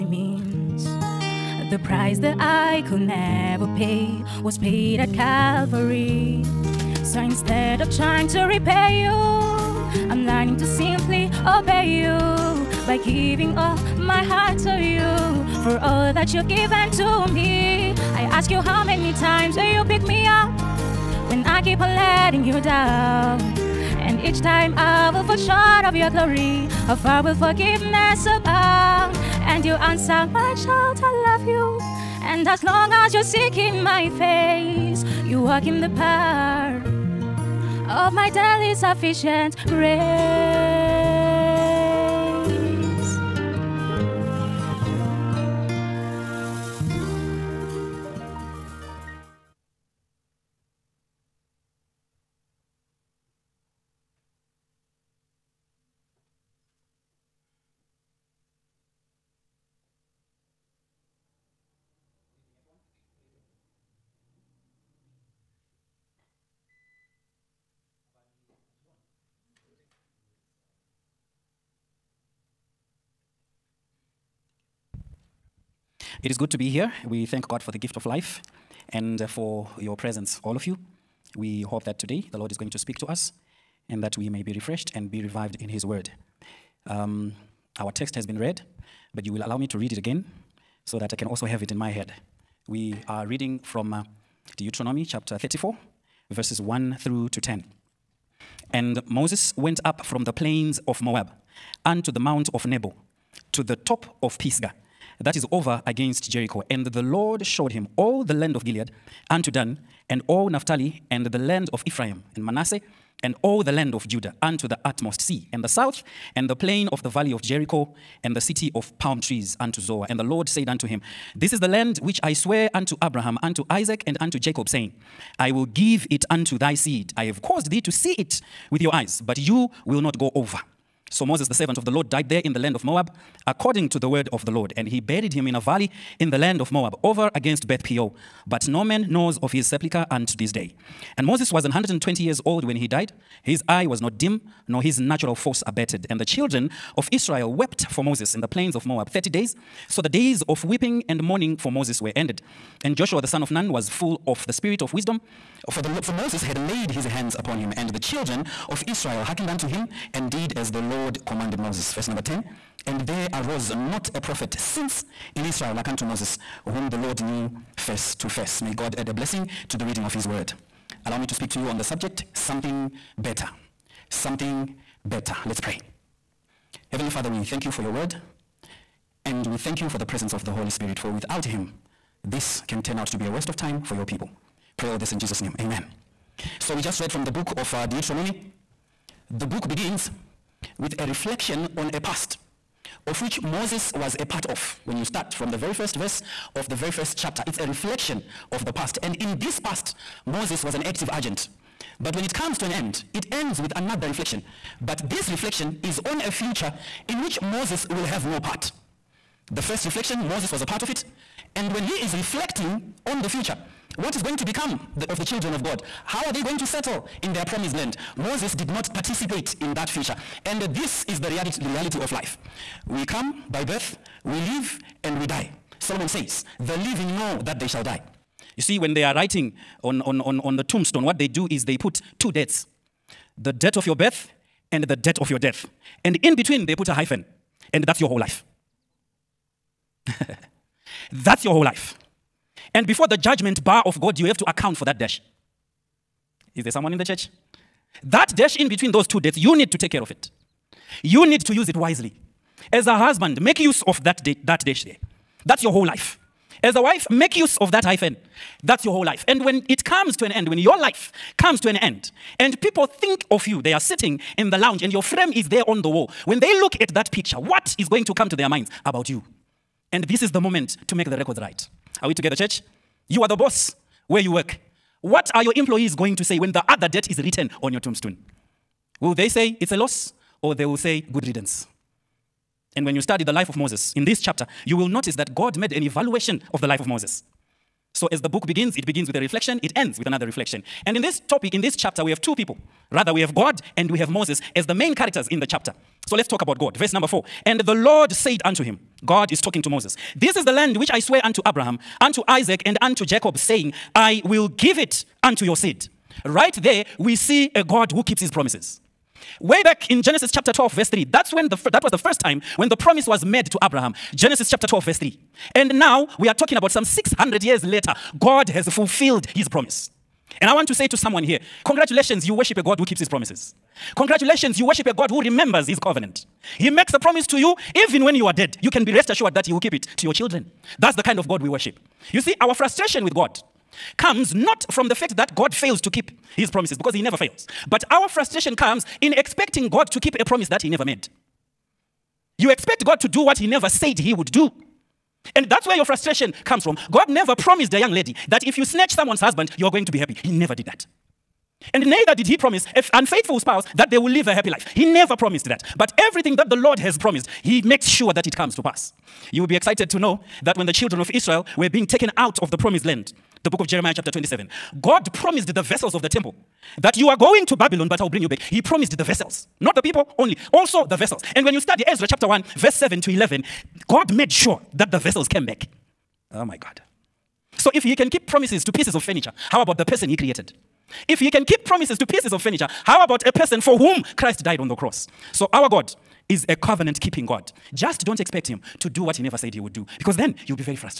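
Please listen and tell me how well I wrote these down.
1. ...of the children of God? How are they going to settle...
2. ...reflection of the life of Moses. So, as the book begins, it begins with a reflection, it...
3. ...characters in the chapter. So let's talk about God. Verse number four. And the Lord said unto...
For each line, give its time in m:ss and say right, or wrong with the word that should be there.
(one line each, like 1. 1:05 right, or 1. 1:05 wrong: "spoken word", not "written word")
1. 3:35 right
2. 4:45 wrong: "evaluation", not "reflection"
3. 4:54 right.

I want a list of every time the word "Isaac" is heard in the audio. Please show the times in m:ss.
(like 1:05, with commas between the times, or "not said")
2:03, 5:02.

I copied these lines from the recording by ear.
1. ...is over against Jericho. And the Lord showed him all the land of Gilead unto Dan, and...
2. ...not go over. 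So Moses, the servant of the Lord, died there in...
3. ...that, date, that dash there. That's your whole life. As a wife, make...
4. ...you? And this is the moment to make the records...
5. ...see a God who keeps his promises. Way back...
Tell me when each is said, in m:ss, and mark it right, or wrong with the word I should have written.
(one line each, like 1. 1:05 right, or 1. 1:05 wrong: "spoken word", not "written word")
1. 1:45 right
2. 2:09 right
3. 4:14 right
4. 4:29 right
5. 5:07 right.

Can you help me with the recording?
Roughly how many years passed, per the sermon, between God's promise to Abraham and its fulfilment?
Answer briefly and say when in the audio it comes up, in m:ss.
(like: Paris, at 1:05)
600, at 5:16.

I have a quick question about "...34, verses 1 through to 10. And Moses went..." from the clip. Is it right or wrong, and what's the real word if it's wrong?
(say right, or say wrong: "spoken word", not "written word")
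right.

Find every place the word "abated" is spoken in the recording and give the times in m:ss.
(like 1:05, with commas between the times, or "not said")
2:25.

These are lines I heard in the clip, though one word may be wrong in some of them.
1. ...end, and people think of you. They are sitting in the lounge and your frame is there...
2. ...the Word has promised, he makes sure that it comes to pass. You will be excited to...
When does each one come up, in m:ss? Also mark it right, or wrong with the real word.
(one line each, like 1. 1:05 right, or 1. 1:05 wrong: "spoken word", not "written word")
1. 4:21 right
2. 5:56 wrong: "Lord", not "Word".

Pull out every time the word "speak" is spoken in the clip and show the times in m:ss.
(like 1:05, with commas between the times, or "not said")
1:22, 2:51.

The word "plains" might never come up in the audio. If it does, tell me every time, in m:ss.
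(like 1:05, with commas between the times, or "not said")
1:40, 1:56, 2:28.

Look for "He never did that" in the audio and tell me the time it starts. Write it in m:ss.
5:50.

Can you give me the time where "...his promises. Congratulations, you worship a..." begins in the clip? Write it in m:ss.
5:22.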